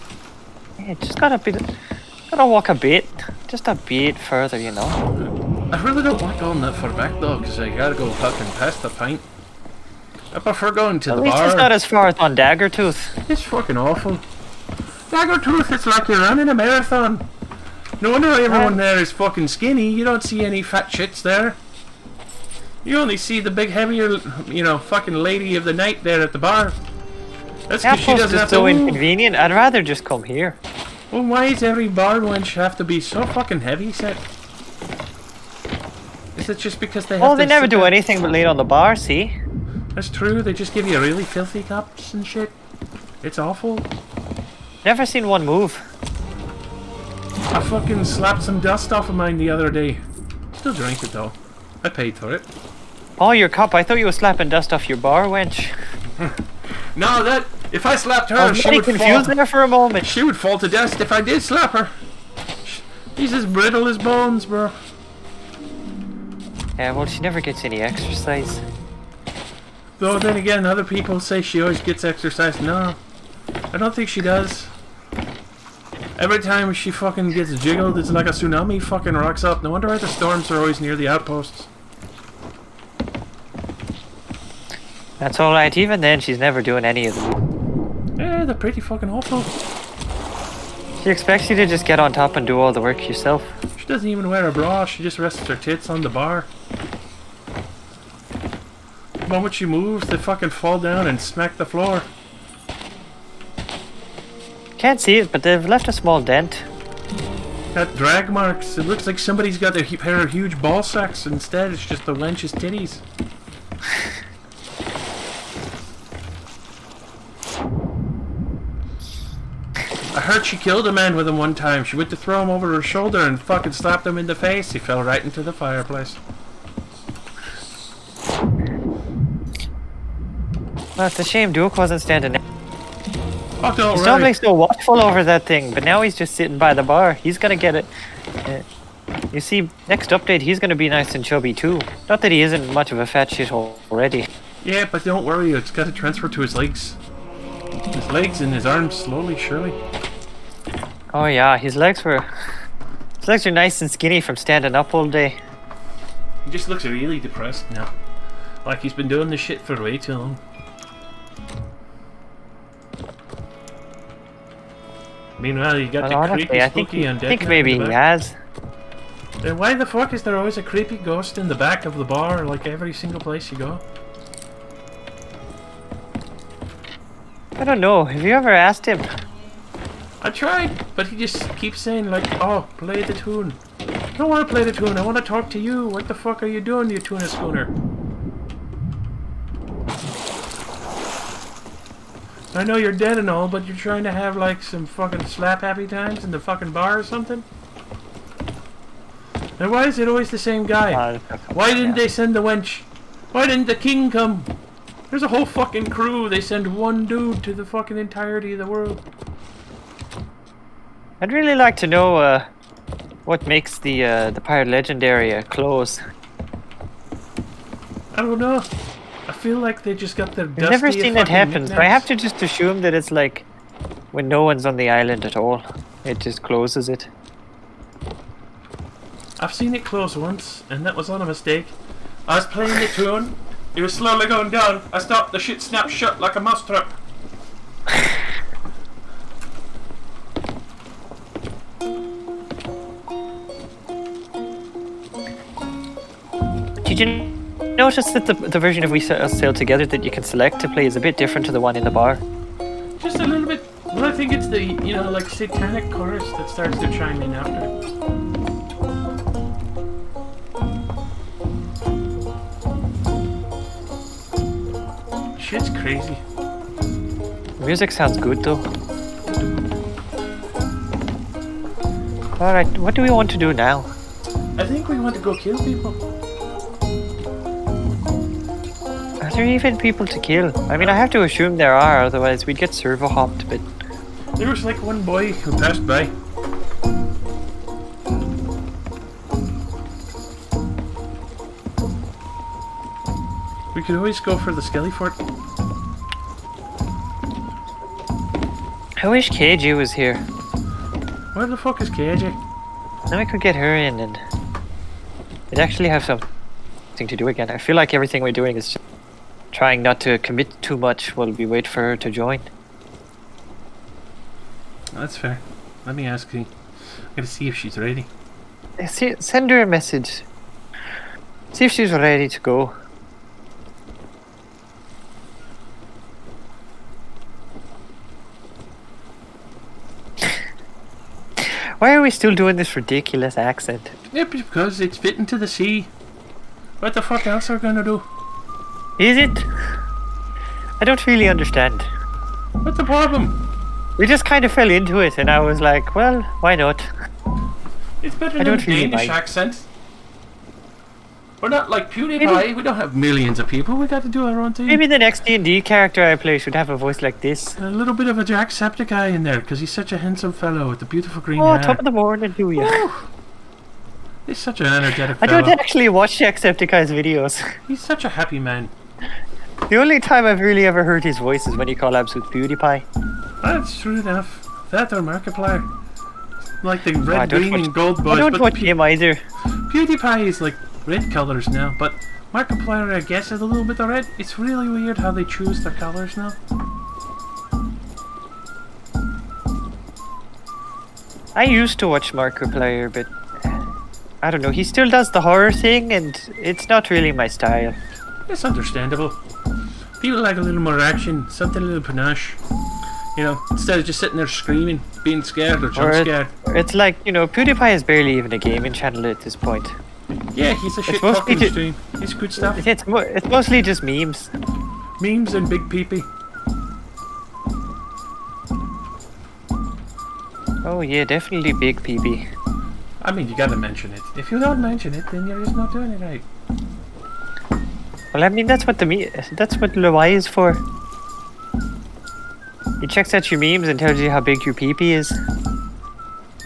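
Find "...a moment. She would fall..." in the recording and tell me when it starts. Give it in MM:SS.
00:59.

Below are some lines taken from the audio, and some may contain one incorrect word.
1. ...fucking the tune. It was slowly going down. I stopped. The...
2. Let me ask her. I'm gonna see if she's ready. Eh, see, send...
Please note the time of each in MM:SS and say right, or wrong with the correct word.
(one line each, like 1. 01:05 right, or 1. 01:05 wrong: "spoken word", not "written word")
1. 03:52 wrong: "playing", not "fucking"
2. 05:15 right.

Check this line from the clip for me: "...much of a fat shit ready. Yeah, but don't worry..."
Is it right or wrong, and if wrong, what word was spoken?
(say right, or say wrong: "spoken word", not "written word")
wrong: "already", not "ready".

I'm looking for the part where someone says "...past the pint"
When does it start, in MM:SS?
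00:08.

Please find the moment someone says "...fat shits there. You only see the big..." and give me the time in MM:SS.
00:20.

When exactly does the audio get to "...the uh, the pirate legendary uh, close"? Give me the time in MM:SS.
03:33.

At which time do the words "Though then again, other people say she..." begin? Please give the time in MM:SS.
01:10.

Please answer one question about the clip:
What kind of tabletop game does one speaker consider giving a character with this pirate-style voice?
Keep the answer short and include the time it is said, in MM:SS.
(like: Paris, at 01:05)
D and D, at 05:55.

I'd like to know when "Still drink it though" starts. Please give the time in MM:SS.
00:50.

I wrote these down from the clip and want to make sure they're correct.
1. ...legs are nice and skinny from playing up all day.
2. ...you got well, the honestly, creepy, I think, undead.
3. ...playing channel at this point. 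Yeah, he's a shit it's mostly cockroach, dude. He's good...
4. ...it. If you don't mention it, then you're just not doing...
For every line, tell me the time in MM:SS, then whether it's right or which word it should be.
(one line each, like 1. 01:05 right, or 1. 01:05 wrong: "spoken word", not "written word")
1. 02:33 wrong: "standing", not "playing"
2. 02:45 right
3. 06:48 wrong: "gaming", not "playing"
4. 07:03 right.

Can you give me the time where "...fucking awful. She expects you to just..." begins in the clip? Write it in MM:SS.
01:28.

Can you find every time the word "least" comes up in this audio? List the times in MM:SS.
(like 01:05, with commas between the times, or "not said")
00:11.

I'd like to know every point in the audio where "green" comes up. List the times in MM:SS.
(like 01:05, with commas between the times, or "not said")
06:01, 06:17.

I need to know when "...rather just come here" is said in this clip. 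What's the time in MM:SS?
00:29.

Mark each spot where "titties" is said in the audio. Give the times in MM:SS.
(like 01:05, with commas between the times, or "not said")
01:52.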